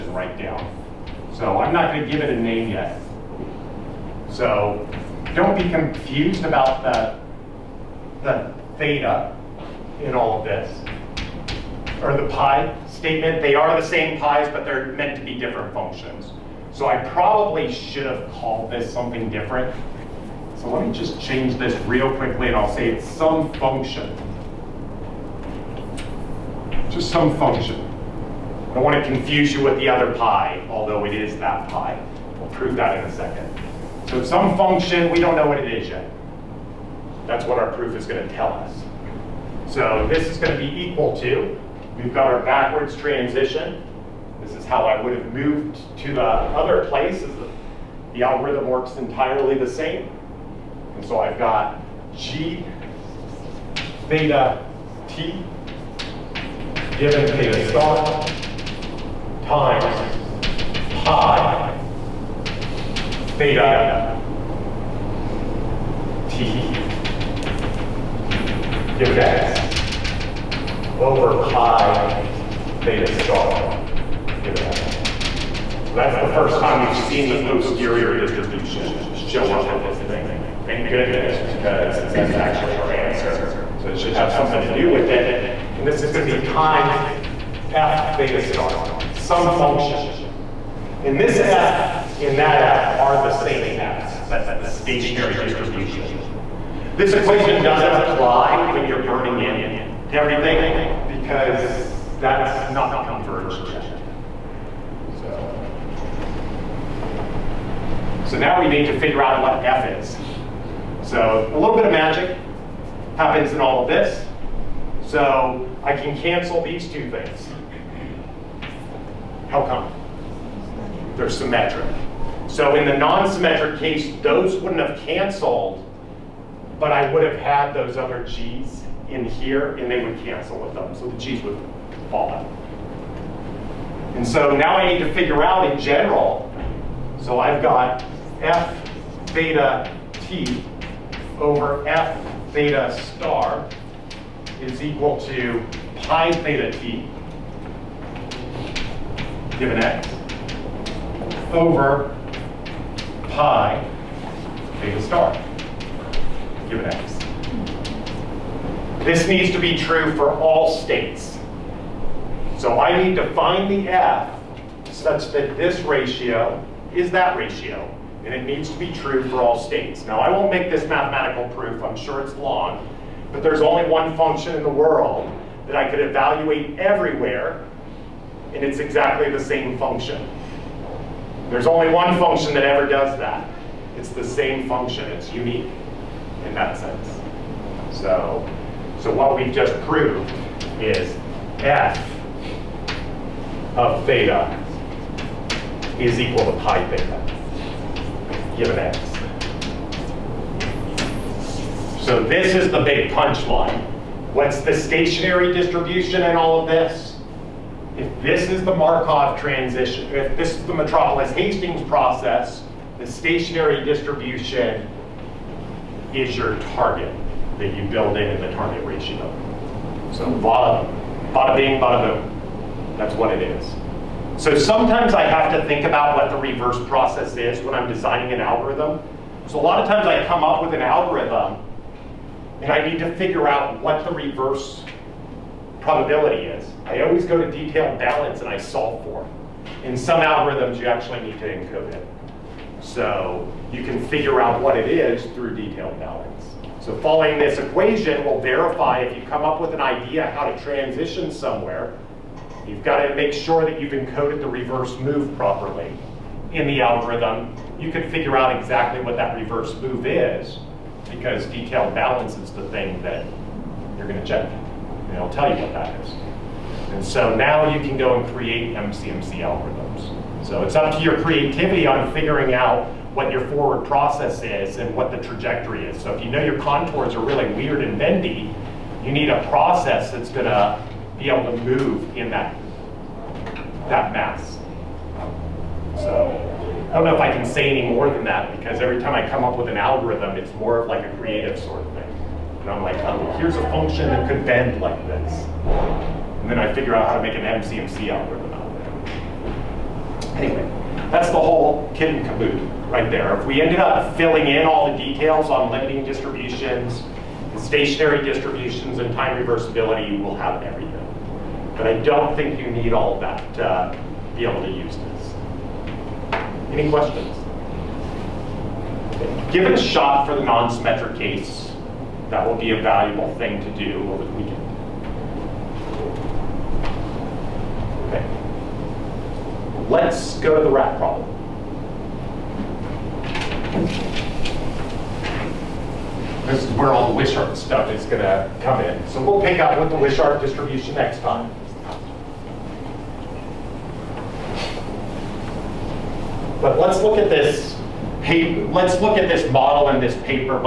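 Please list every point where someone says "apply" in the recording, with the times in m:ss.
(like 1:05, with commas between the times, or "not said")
1:38.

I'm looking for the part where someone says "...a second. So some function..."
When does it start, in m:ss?
0:33.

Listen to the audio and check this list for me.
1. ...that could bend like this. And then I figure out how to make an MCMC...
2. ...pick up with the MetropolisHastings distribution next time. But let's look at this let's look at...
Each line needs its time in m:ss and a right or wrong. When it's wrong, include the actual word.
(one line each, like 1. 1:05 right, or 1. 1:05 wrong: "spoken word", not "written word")
1. 4:54 right
2. 5:39 wrong: "Wishart", not "MetropolisHastings".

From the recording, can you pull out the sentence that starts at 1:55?
So I can cancel these two things.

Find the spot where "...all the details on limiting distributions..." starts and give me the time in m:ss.
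5:04.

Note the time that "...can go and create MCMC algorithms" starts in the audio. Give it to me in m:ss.
4:27.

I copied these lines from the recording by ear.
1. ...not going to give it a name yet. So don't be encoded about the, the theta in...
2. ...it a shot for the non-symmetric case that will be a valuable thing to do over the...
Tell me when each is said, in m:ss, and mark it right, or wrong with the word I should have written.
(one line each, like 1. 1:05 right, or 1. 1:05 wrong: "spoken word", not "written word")
1. 0:01 wrong: "confused", not "encoded"
2. 5:19 right.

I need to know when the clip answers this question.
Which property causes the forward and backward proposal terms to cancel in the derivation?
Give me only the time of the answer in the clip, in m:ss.
2:01.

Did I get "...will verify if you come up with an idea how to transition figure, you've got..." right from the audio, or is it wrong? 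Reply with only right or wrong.
wrong.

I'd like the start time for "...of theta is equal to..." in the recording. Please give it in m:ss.
3:13.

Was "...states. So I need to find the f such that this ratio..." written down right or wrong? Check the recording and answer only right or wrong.
right.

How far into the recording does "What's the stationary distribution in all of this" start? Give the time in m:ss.
3:24.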